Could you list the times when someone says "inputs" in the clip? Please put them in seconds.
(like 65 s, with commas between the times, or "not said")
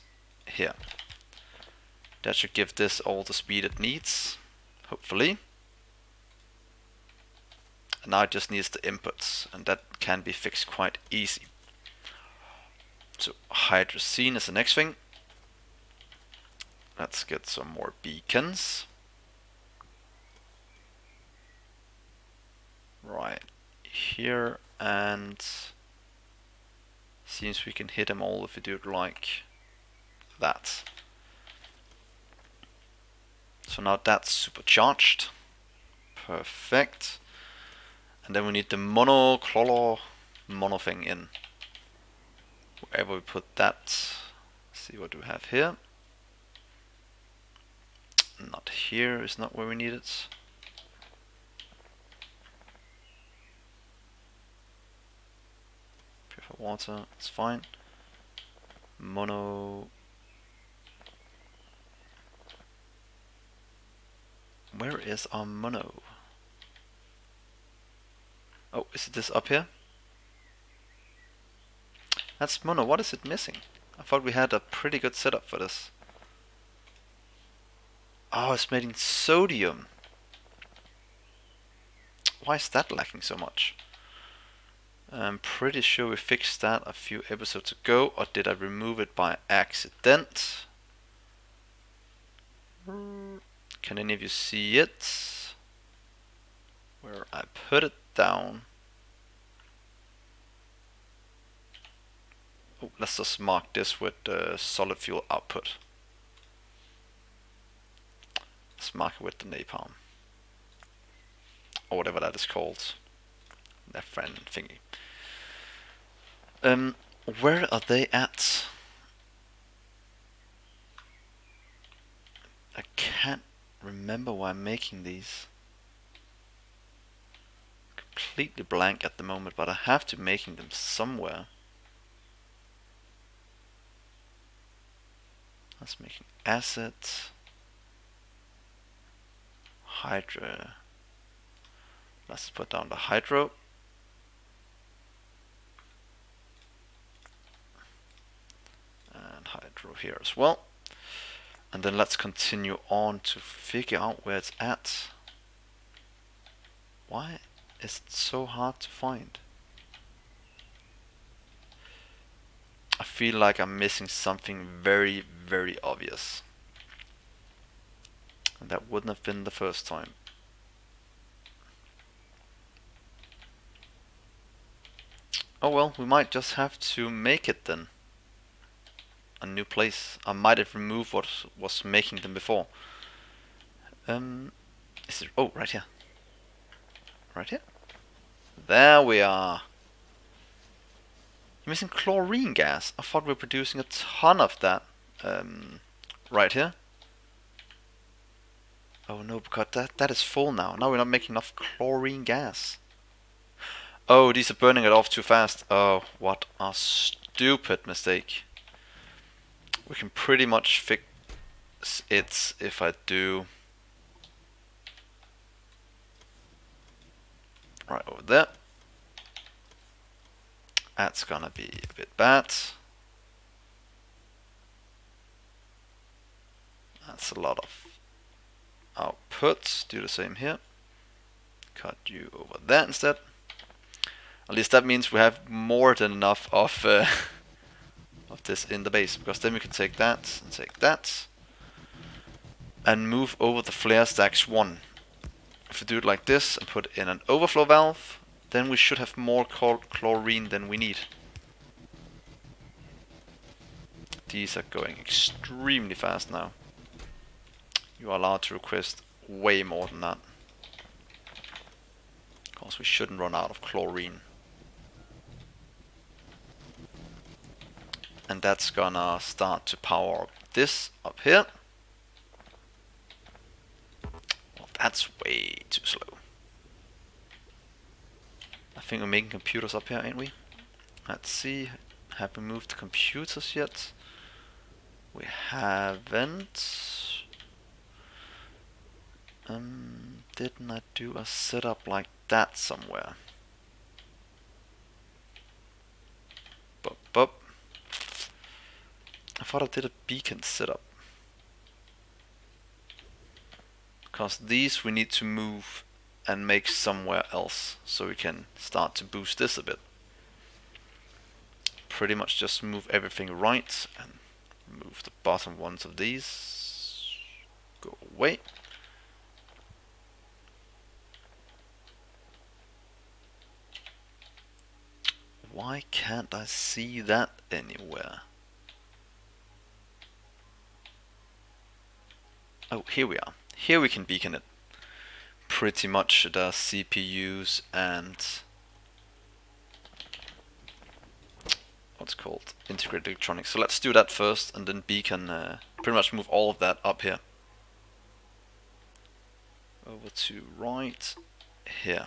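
8 s.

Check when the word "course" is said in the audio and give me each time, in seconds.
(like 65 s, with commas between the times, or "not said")
262 s.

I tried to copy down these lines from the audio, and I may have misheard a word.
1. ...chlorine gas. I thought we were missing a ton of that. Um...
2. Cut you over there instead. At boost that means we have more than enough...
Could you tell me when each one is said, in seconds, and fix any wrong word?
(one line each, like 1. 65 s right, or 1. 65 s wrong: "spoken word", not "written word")
1. 191 s wrong: "producing", not "missing"
2. 231 s wrong: "least", not "boost".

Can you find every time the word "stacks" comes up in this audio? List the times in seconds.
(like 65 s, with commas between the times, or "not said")
244 s.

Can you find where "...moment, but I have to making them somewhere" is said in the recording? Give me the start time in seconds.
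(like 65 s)
129 s.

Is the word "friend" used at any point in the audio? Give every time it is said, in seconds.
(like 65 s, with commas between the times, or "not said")
114 s.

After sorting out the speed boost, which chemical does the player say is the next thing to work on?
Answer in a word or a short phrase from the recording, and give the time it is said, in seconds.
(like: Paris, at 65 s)
Hydrazine, at 13 s.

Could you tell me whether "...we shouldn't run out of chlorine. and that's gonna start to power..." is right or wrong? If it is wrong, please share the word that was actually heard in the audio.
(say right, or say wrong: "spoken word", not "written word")
right.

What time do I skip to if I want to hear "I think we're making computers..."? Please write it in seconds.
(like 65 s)
278 s.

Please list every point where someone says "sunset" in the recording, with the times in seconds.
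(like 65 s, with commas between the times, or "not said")
not said.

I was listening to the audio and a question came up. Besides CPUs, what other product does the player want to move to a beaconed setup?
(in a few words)
Integrated electronics.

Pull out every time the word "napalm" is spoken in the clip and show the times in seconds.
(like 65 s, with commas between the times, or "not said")
109 s.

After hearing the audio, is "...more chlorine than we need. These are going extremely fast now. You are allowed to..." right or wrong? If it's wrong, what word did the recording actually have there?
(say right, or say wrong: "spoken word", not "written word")
right.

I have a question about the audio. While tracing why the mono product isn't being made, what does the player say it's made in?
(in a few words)
Sodium.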